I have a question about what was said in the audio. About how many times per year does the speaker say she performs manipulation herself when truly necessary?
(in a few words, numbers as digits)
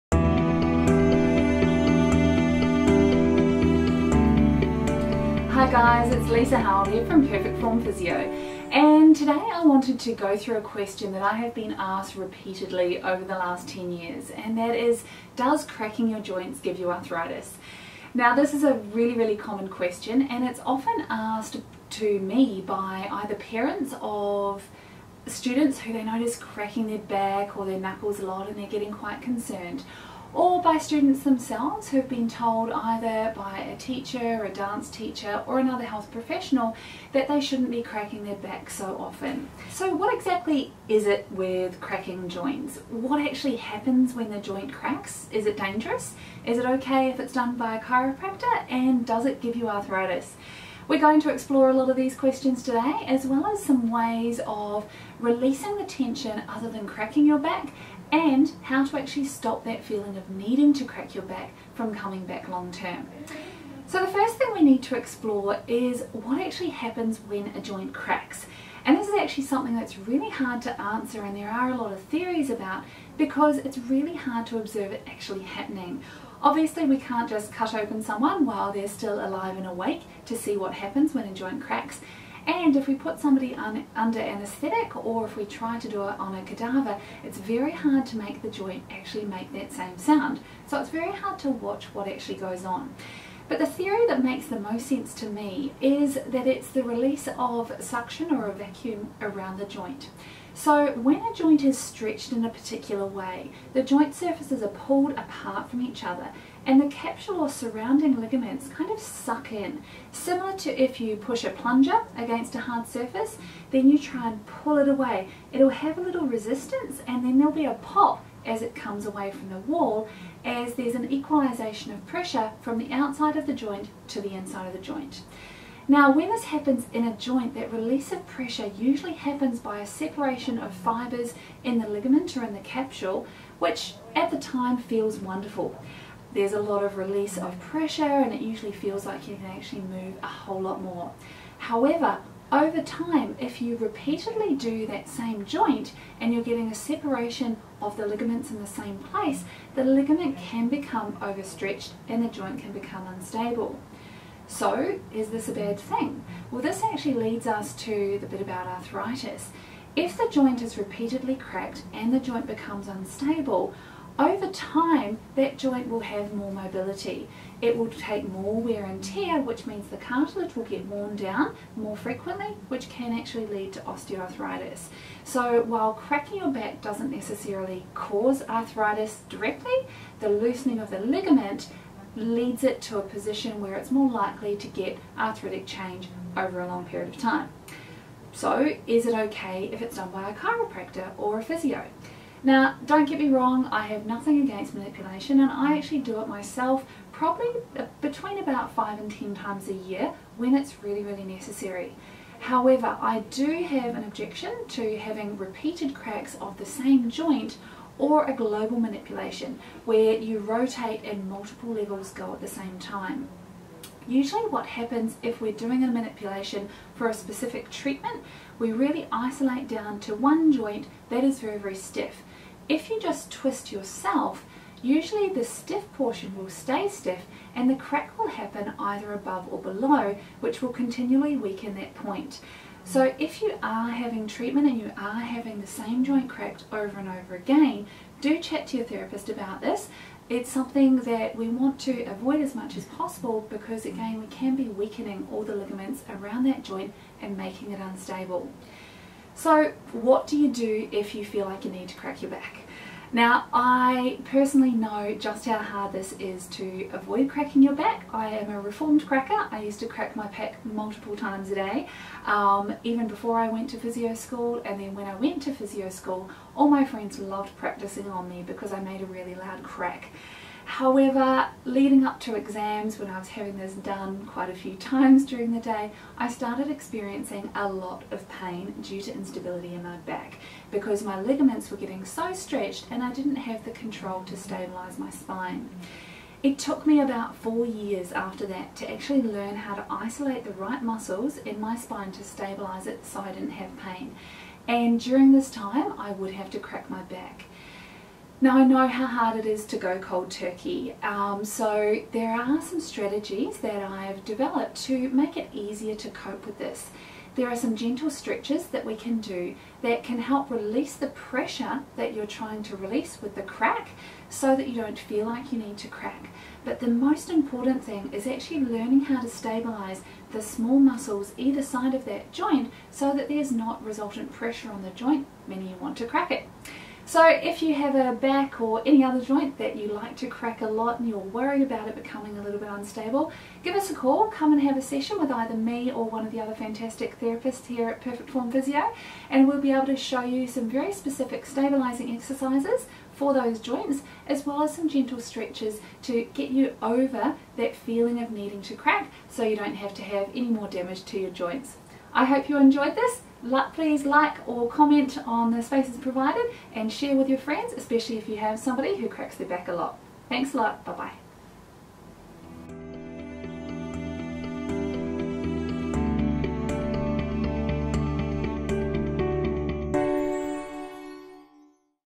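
5 to 10.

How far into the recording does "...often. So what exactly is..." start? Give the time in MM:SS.
00:38.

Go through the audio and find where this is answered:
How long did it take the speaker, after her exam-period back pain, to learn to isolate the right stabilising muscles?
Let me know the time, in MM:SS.
04:47.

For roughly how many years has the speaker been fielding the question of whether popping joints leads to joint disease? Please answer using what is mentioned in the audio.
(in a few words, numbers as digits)
10 years.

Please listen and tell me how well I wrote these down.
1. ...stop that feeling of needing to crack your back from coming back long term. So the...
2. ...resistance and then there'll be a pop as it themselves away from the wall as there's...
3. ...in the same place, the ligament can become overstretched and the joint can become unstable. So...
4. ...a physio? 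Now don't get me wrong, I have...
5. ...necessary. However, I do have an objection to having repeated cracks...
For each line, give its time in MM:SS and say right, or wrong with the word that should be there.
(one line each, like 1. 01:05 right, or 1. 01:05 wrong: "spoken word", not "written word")
1. 00:59 right
2. 01:56 wrong: "comes", not "themselves"
3. 02:28 right
4. 03:11 right
5. 03:21 right.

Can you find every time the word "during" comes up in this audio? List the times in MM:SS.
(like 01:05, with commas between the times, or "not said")
04:35, 04:54.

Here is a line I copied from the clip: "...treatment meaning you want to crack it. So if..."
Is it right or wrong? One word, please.
wrong.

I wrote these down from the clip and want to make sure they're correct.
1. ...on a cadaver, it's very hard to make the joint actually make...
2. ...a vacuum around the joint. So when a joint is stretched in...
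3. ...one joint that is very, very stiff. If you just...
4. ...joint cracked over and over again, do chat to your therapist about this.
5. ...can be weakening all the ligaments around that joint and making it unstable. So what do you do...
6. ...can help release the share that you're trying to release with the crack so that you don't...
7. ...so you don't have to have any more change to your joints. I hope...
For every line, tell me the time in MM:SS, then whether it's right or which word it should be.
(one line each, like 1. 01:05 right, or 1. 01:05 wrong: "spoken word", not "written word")
1. 01:26 right
2. 01:38 right
3. 03:40 right
4. 03:56 right
5. 04:04 right
6. 05:10 wrong: "pressure", not "share"
7. 05:49 wrong: "damage", not "change".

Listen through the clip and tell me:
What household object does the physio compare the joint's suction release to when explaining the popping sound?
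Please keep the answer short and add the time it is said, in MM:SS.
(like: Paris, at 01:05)
plunger, at 01:51.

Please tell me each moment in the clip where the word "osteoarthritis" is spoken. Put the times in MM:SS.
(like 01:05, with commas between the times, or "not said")
02:53.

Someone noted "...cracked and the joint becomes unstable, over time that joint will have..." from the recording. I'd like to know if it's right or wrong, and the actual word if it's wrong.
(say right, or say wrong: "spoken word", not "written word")
right.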